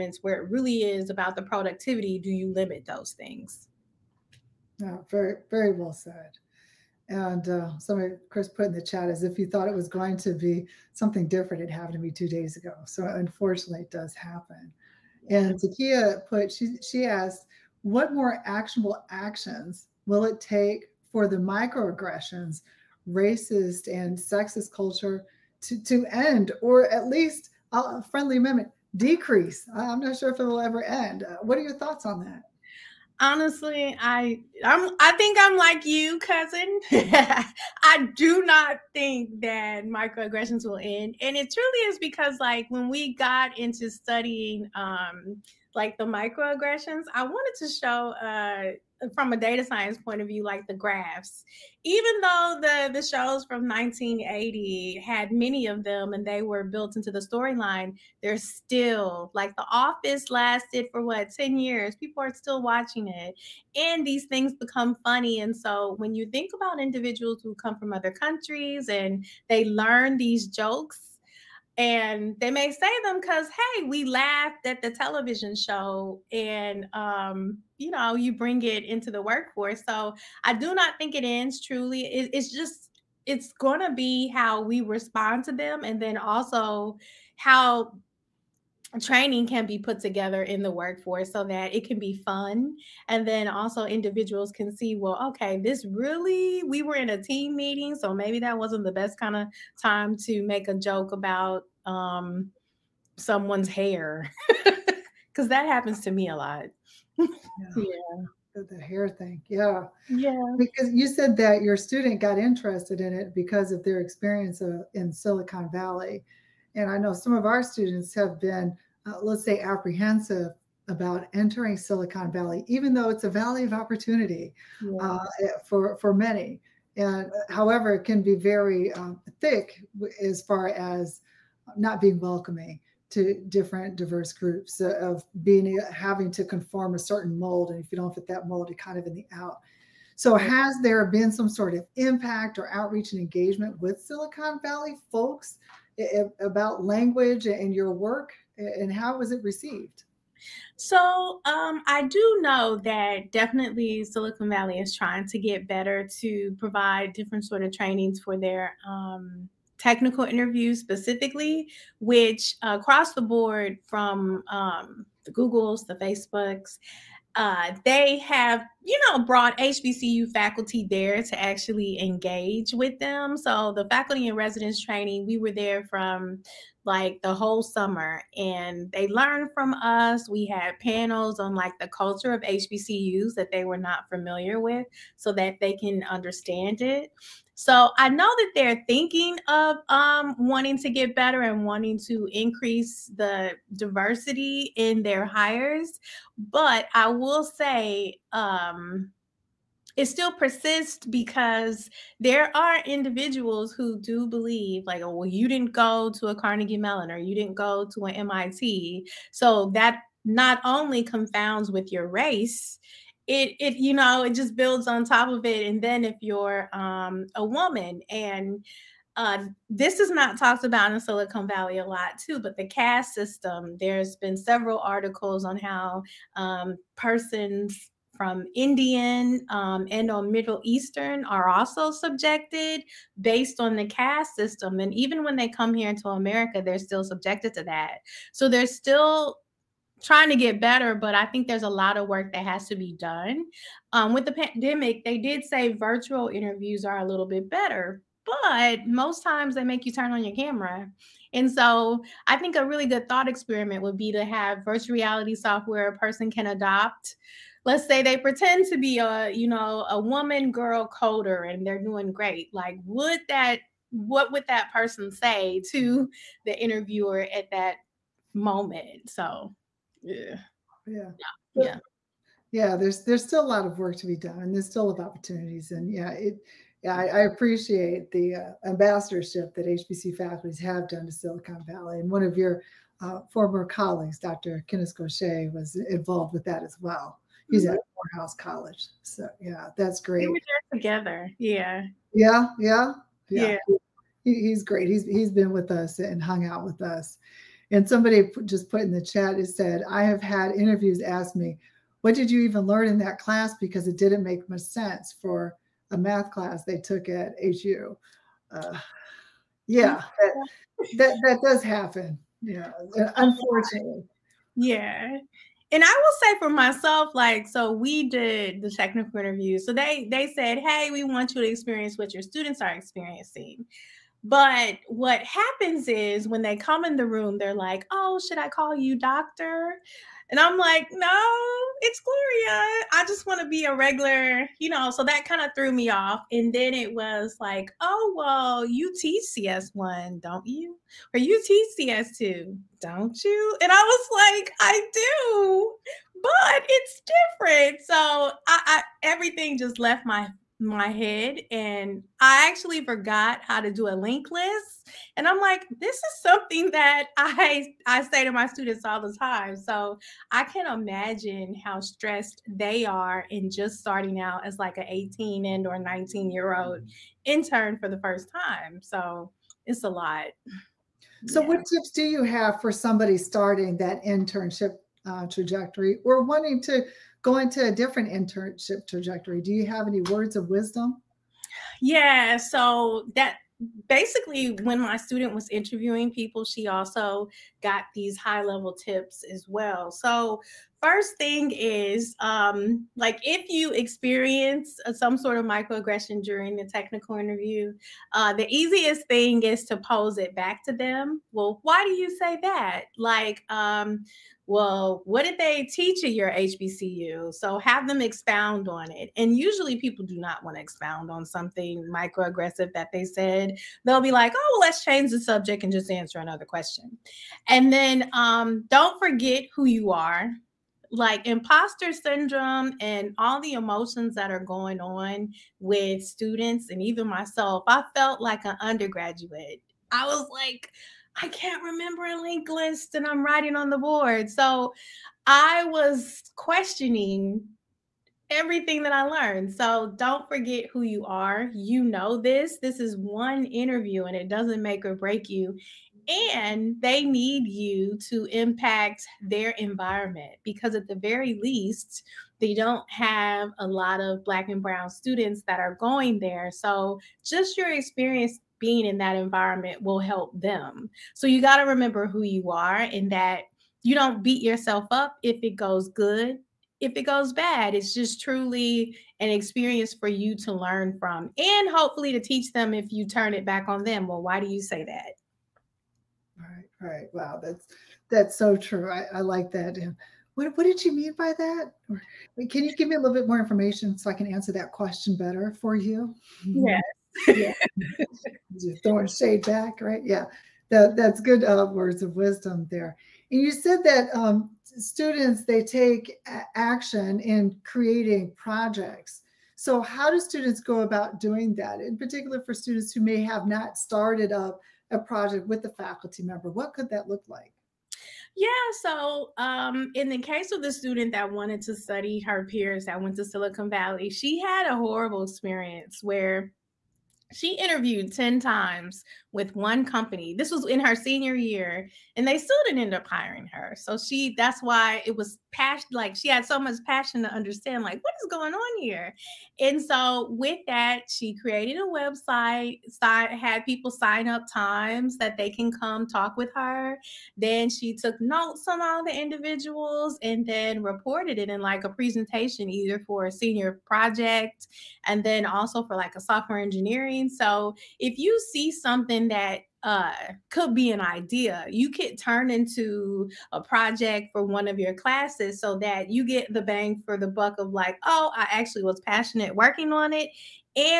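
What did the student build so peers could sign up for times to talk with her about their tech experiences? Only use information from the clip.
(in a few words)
a website.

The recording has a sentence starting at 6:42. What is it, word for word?
Like, um, well, what did they teach at your HBCU?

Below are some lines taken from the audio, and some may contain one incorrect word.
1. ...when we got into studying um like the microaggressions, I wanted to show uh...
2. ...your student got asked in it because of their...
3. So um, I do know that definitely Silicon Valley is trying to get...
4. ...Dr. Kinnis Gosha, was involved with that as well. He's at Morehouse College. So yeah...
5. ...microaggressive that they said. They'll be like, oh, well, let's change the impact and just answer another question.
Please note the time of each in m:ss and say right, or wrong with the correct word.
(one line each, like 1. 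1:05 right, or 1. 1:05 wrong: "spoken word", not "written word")
1. 0:42 right
2. 1:51 wrong: "interested", not "asked"
3. 2:30 right
4. 4:44 right
5. 6:51 wrong: "subject", not "impact".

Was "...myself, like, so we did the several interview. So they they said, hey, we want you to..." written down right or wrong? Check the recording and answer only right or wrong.
wrong.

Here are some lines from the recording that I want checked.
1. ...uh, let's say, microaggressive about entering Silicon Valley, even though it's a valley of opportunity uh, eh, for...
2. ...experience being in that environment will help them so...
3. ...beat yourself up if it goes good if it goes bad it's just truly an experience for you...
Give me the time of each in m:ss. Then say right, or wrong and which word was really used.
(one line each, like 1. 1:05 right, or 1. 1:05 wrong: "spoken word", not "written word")
1. 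1:59 wrong: "apprehensive", not "microaggressive"
2. 7:37 right
3. 7:44 right.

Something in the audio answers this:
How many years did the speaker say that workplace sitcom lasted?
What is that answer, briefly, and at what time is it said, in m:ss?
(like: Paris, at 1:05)
10, at 1:01.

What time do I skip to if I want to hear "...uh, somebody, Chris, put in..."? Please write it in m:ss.
0:07.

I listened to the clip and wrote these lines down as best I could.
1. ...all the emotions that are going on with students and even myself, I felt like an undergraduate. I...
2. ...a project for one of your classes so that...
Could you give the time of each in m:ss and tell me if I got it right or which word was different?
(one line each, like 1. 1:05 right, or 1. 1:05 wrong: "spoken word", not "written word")
1. 7:03 right
2. 9:13 right.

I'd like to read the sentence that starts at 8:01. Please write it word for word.
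Or, can you give me a little bit more information so I can answer that question better for you?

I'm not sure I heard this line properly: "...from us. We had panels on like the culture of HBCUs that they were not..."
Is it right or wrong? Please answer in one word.
right.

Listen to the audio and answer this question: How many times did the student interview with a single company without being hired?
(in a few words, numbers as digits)
10.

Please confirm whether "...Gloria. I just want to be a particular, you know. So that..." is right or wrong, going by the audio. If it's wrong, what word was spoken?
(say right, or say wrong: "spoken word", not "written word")
wrong: "regular", not "particular".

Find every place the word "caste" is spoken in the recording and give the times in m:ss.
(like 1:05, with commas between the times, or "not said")
3:42, 3:53.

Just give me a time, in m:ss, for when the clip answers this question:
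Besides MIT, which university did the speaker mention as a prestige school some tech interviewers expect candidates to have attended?
3:26.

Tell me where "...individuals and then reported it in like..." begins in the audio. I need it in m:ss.
8:59.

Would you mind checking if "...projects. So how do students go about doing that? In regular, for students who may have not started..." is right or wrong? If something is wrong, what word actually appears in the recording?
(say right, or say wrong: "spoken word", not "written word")
wrong: "particular", not "regular".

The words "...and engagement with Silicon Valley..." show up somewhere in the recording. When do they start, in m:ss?
2:23.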